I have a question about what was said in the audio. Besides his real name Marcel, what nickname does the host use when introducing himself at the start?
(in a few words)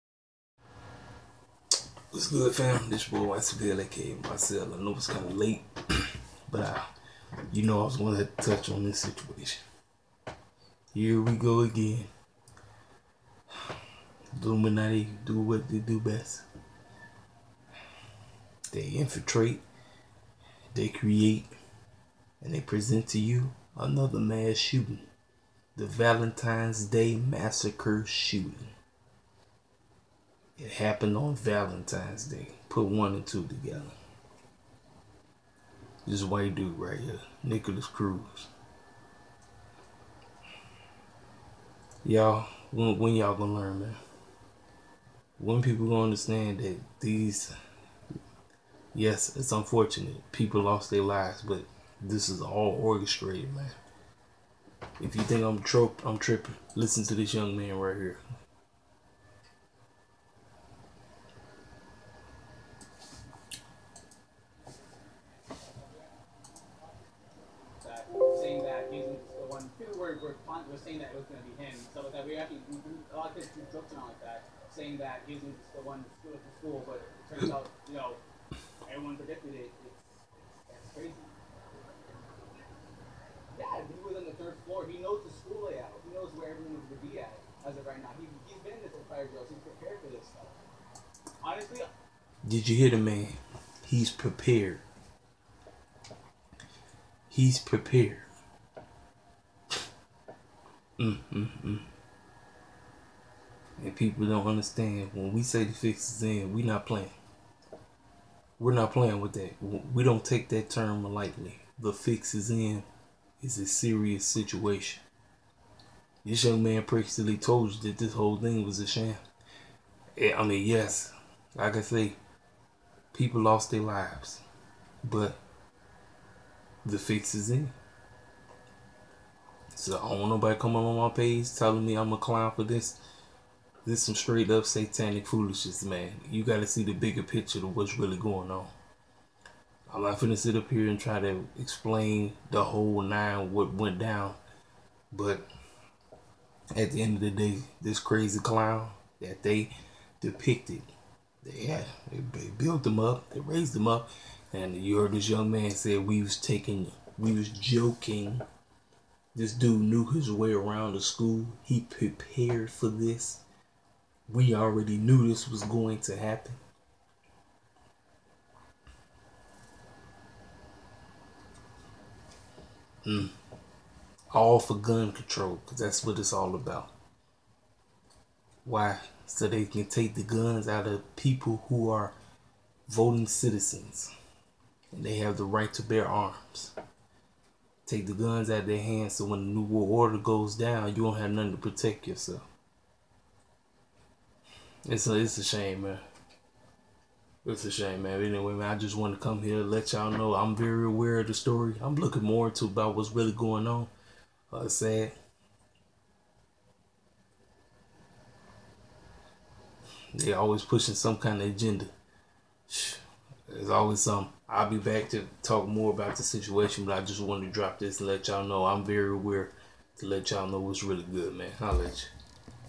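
Wise Bill.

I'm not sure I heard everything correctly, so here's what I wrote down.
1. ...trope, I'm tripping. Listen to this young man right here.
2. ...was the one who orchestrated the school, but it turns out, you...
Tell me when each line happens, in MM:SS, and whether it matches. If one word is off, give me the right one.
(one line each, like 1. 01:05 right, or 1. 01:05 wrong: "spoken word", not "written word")
1. 00:55 right
2. 01:15 wrong: "screwed", not "orchestrated".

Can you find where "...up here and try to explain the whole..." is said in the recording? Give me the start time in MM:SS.
02:20.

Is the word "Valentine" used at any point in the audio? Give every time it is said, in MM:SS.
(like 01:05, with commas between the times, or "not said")
00:25, 00:31.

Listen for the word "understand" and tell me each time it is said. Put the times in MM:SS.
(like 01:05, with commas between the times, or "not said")
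00:46, 01:44.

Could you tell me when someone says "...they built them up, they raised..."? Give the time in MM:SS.
02:32.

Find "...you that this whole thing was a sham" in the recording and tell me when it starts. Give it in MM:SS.
01:57.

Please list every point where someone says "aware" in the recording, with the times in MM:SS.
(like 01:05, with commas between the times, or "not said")
03:20, 03:39.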